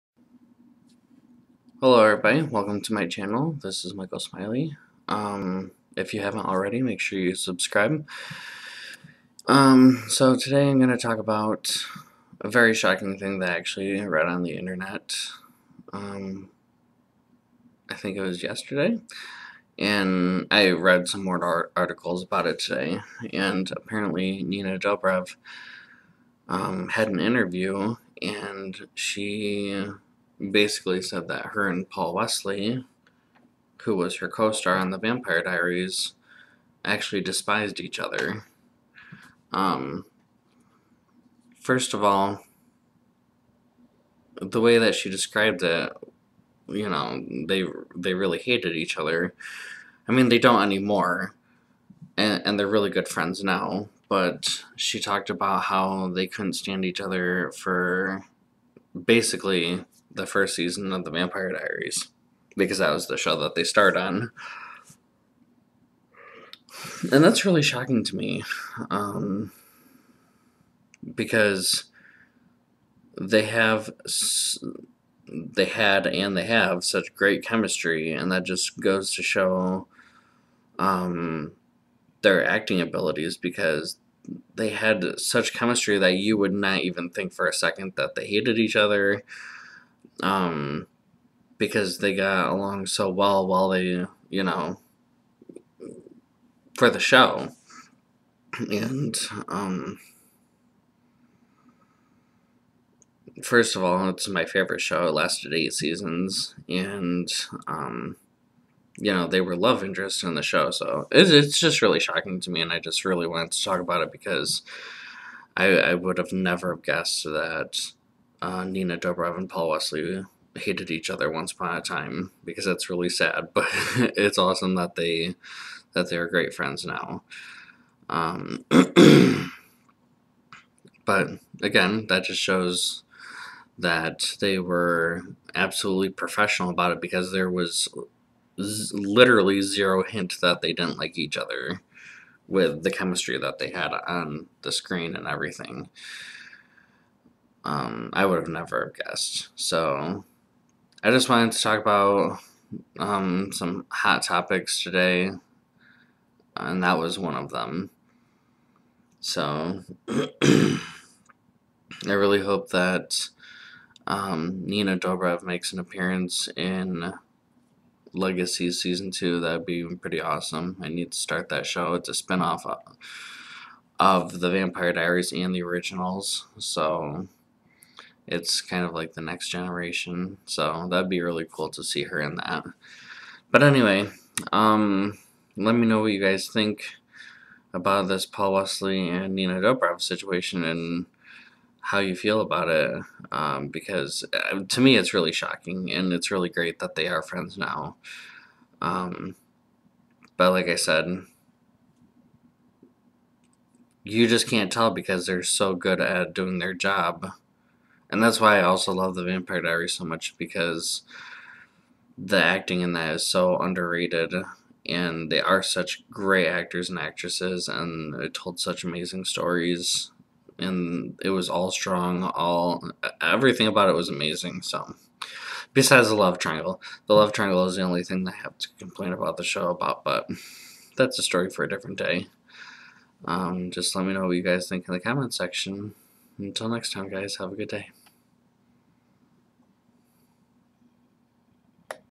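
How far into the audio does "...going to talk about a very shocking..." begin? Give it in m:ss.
0:10.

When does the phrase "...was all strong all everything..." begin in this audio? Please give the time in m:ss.
3:41.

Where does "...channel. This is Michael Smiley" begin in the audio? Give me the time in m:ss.
0:03.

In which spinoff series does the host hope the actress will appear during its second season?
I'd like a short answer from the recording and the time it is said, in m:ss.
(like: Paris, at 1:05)
Legacy, at 2:48.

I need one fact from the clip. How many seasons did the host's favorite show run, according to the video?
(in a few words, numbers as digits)
8.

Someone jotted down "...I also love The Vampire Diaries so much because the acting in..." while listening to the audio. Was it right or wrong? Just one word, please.
right.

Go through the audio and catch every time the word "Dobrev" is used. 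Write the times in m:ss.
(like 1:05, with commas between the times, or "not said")
0:24, 1:58, 2:44, 3:09.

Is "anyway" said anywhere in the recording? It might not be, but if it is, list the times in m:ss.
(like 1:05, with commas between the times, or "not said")
3:03.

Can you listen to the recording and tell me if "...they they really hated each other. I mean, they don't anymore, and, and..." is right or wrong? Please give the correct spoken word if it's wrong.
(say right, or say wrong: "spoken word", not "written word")
right.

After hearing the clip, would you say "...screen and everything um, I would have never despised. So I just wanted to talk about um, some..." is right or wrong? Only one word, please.
wrong.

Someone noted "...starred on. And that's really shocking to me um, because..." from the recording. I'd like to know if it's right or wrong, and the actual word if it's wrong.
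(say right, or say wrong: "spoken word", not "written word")
right.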